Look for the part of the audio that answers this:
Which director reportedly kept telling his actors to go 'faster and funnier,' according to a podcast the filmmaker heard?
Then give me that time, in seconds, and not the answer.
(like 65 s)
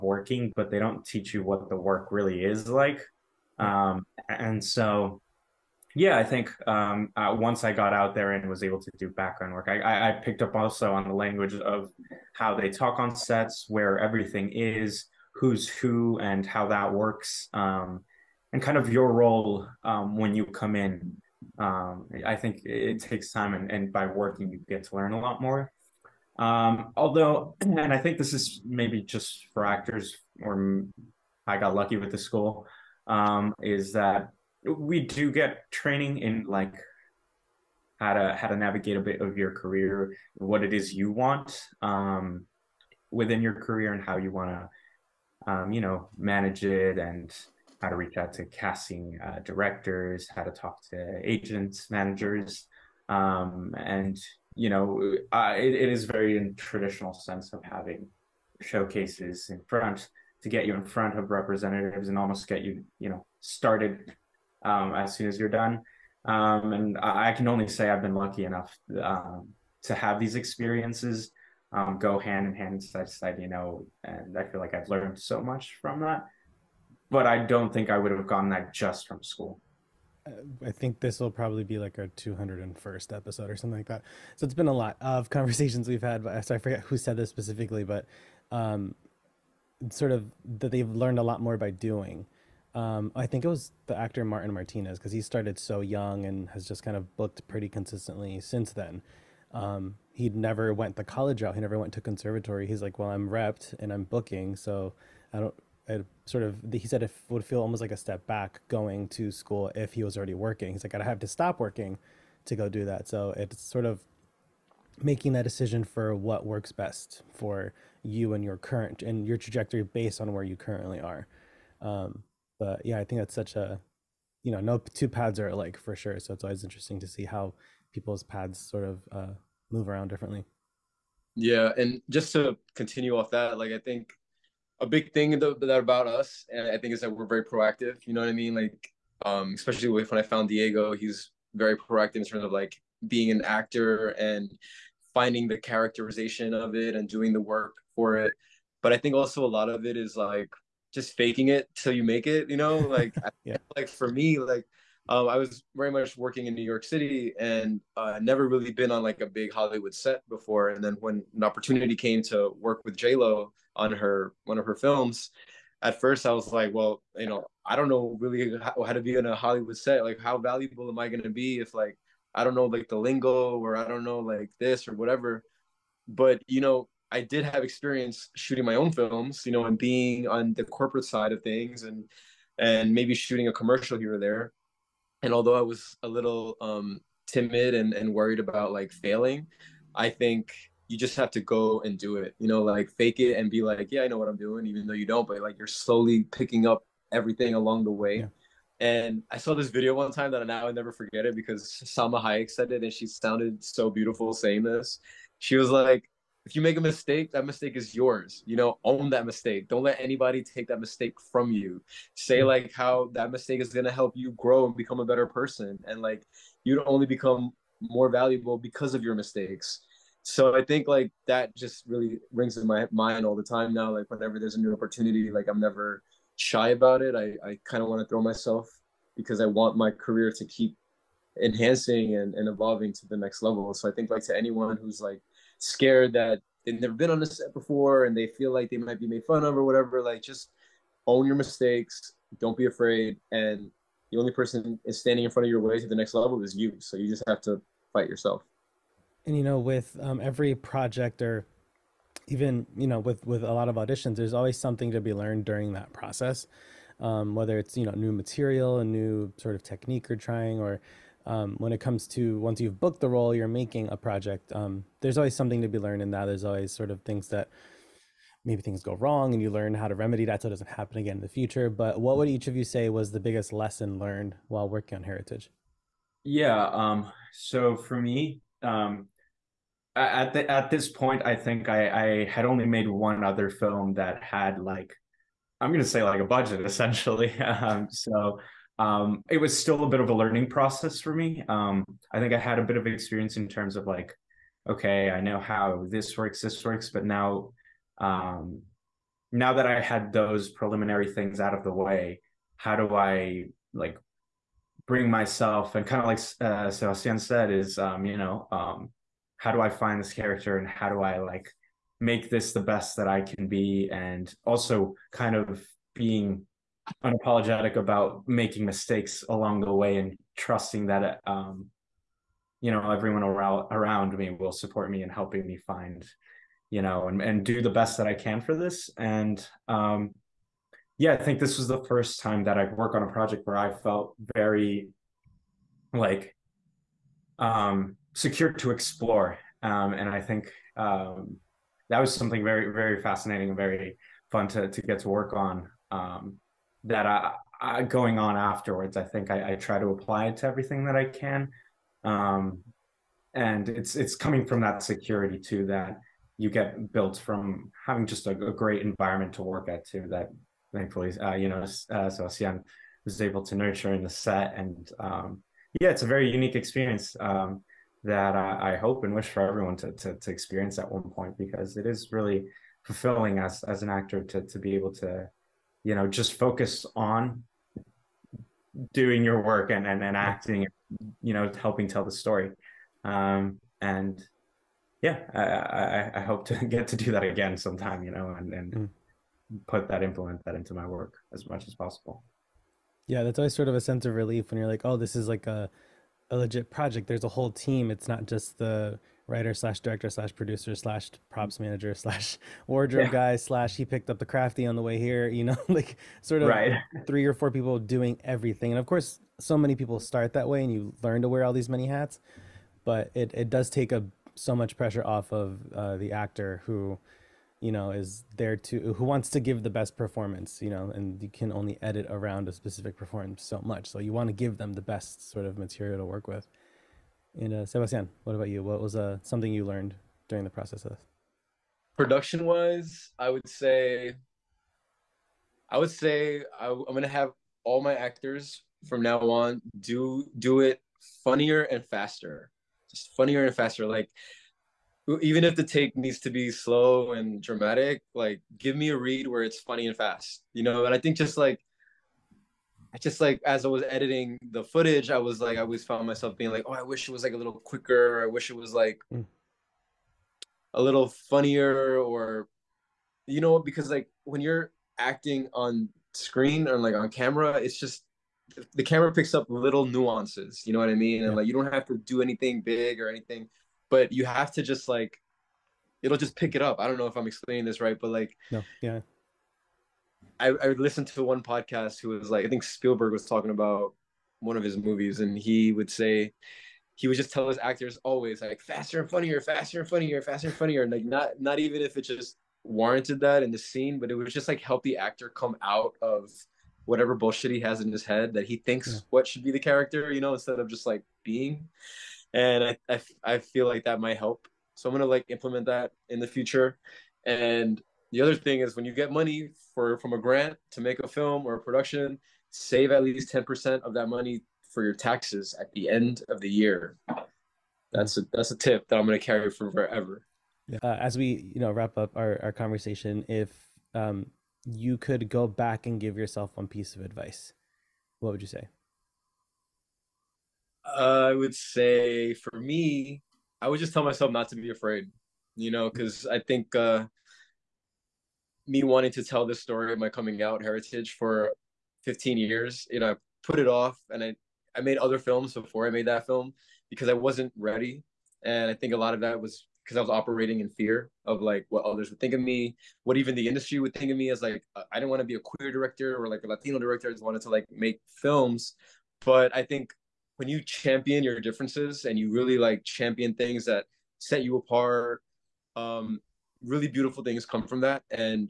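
482 s.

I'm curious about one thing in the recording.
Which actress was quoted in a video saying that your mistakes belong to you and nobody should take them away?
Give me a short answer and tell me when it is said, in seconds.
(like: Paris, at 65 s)
Salma Hayek, at 201 s.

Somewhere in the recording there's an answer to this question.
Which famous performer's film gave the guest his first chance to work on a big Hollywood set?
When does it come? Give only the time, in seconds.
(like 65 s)
162 s.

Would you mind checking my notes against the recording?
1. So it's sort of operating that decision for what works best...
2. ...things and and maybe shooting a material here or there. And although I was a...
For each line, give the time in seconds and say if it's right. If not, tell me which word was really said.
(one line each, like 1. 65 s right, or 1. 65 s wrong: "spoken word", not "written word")
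1. 113 s wrong: "making", not "operating"
2. 181 s wrong: "commercial", not "material".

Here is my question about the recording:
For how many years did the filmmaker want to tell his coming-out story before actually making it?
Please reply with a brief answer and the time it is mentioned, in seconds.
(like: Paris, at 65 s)
15 years, at 542 s.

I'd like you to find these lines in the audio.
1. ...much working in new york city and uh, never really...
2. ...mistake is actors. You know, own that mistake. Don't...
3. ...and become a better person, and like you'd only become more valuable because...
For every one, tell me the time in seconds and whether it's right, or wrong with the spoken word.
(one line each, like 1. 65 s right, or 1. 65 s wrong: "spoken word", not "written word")
1. 155 s right
2. 207 s wrong: "yours", not "actors"
3. 214 s right.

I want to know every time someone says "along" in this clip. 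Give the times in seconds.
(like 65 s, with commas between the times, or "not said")
197 s, 319 s.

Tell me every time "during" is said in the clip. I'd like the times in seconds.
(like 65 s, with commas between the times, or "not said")
255 s, 430 s.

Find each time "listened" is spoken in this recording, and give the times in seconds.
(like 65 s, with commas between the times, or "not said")
480 s.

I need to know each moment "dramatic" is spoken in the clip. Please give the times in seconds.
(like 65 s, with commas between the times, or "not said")
447 s.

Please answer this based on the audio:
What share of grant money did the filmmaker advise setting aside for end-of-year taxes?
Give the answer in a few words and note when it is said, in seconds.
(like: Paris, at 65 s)
10%, at 513 s.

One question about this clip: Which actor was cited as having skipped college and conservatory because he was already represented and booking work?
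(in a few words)
Martin Martinez.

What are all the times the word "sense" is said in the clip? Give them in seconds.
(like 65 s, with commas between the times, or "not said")
57 s, 393 s.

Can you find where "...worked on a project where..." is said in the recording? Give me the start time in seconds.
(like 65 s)
332 s.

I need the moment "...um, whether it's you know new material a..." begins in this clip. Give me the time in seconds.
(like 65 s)
256 s.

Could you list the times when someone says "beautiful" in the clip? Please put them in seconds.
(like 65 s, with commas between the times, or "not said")
203 s, 566 s.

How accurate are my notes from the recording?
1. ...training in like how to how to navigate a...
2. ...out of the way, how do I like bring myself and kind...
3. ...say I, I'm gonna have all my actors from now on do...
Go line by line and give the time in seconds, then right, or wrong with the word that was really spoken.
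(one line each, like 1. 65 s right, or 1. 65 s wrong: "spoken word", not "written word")
1. 35 s right
2. 301 s right
3. 435 s right.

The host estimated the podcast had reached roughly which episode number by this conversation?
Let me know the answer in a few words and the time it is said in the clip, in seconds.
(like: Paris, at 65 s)
201st, at 82 s.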